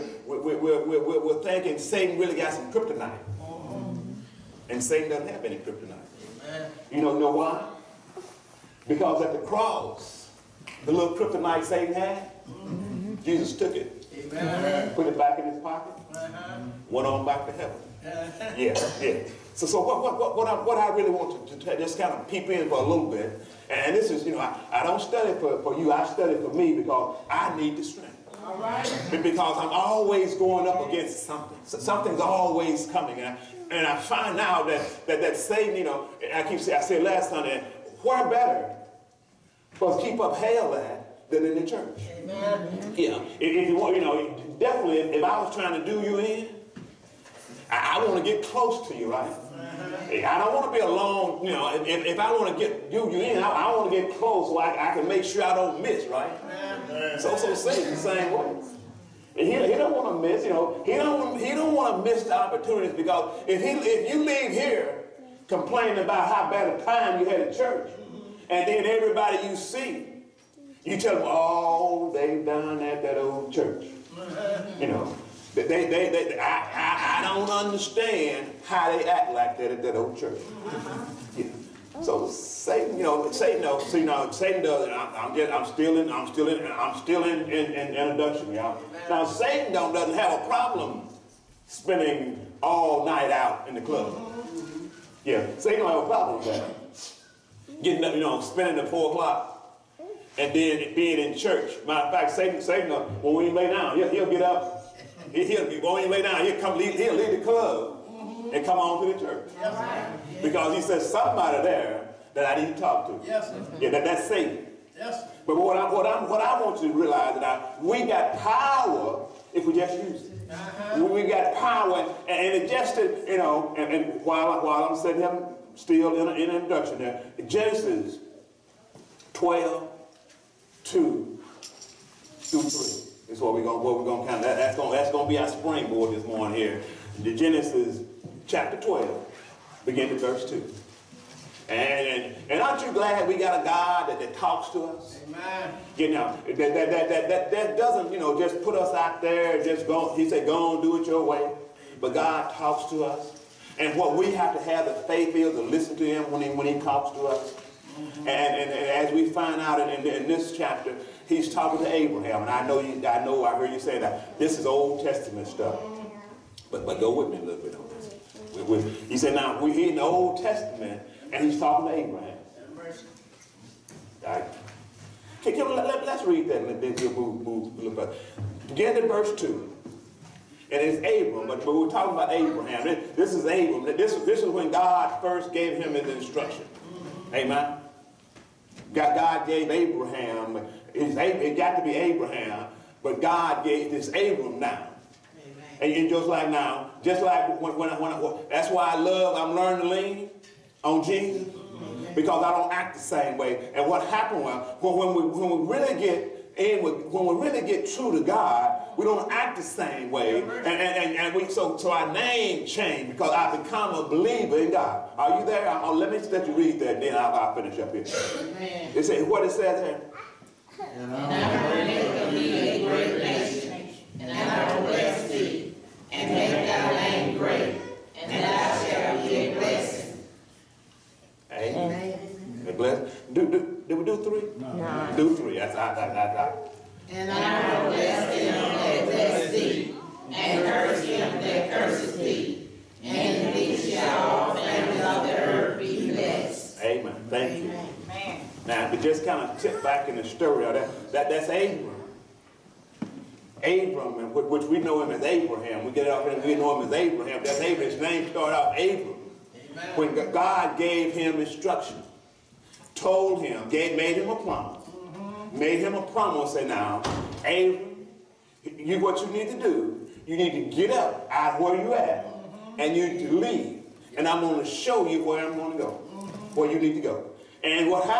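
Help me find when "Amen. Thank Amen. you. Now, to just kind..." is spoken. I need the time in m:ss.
4:06.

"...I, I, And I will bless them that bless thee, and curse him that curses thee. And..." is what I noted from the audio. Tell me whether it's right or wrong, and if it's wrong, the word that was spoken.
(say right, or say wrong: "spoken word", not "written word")
right.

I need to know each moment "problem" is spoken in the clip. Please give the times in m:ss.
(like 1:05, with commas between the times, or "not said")
1:30, 1:36.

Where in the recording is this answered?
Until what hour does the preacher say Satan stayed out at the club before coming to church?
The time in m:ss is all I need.
1:38.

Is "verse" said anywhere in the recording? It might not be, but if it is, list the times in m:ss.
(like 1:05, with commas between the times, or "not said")
2:20, 2:59.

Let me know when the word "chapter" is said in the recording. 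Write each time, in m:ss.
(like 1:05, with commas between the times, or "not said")
2:18, 2:40.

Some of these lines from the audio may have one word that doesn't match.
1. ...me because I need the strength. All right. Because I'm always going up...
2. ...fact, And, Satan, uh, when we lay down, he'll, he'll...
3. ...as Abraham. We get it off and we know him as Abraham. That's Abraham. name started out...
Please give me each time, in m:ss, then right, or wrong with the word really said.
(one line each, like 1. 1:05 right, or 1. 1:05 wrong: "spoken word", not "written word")
1. 0:26 right
2. 1:42 wrong: "Satan", not "And"
3. 4:15 right.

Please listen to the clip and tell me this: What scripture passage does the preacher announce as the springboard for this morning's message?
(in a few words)
Genesis 12:2-3.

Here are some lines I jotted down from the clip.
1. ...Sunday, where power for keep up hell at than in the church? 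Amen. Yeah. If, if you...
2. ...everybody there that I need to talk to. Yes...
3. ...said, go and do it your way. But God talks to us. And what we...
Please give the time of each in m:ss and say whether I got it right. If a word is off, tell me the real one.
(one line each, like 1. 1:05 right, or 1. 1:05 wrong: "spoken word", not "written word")
1. 0:37 wrong: "better", not "power"
2. 1:51 wrong: "somebody", not "everybody"
3. 2:30 right.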